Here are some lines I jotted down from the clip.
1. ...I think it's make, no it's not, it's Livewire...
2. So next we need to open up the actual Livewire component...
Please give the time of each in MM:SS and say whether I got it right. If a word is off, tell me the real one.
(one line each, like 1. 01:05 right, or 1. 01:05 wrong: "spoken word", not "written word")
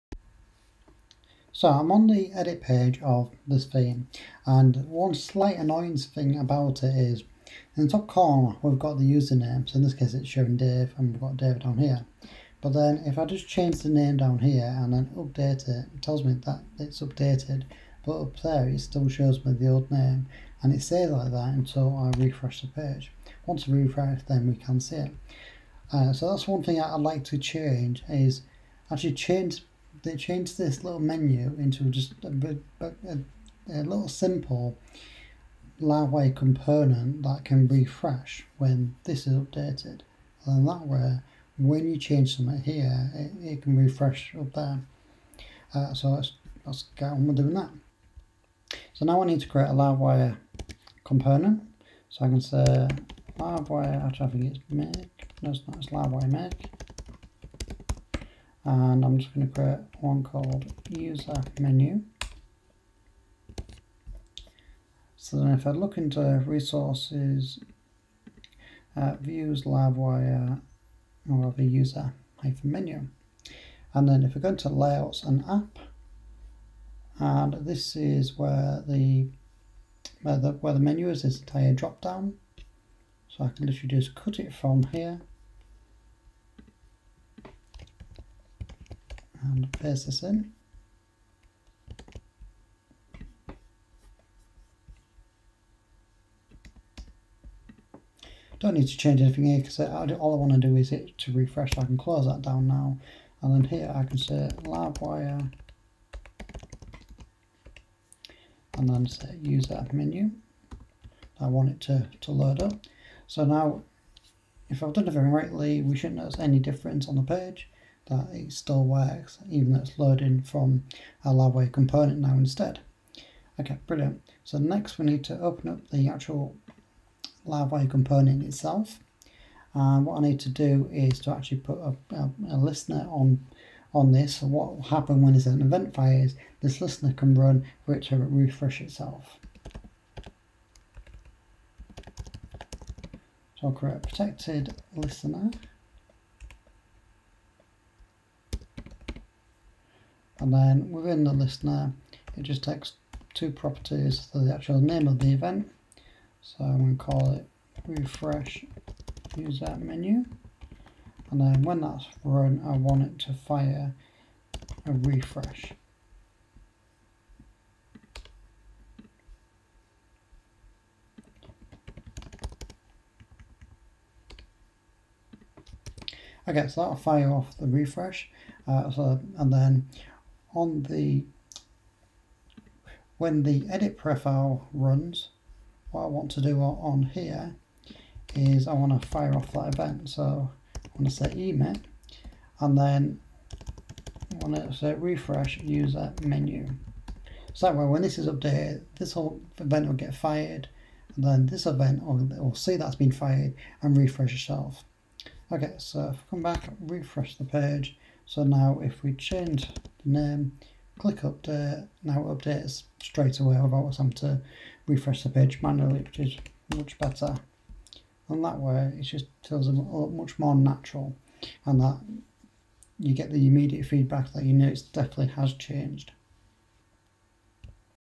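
1. 00:54 right
2. 02:04 right.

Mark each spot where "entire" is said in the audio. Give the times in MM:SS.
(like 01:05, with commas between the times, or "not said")
01:21.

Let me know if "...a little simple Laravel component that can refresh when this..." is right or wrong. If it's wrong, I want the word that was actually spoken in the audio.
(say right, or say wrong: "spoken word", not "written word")
right.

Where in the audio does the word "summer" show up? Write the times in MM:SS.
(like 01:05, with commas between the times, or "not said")
not said.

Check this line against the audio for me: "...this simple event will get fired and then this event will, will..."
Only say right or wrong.
wrong.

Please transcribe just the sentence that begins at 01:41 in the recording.
I can close that down now and then here I can say livewire and then say use that menu.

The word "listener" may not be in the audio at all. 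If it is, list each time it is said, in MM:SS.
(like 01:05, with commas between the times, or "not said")
02:12, 02:16, 02:24, 02:31.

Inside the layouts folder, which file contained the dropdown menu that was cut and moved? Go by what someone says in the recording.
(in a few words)
app.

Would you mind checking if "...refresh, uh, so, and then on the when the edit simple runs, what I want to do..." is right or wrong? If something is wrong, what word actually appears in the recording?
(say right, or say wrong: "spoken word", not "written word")
wrong: "profile", not "simple".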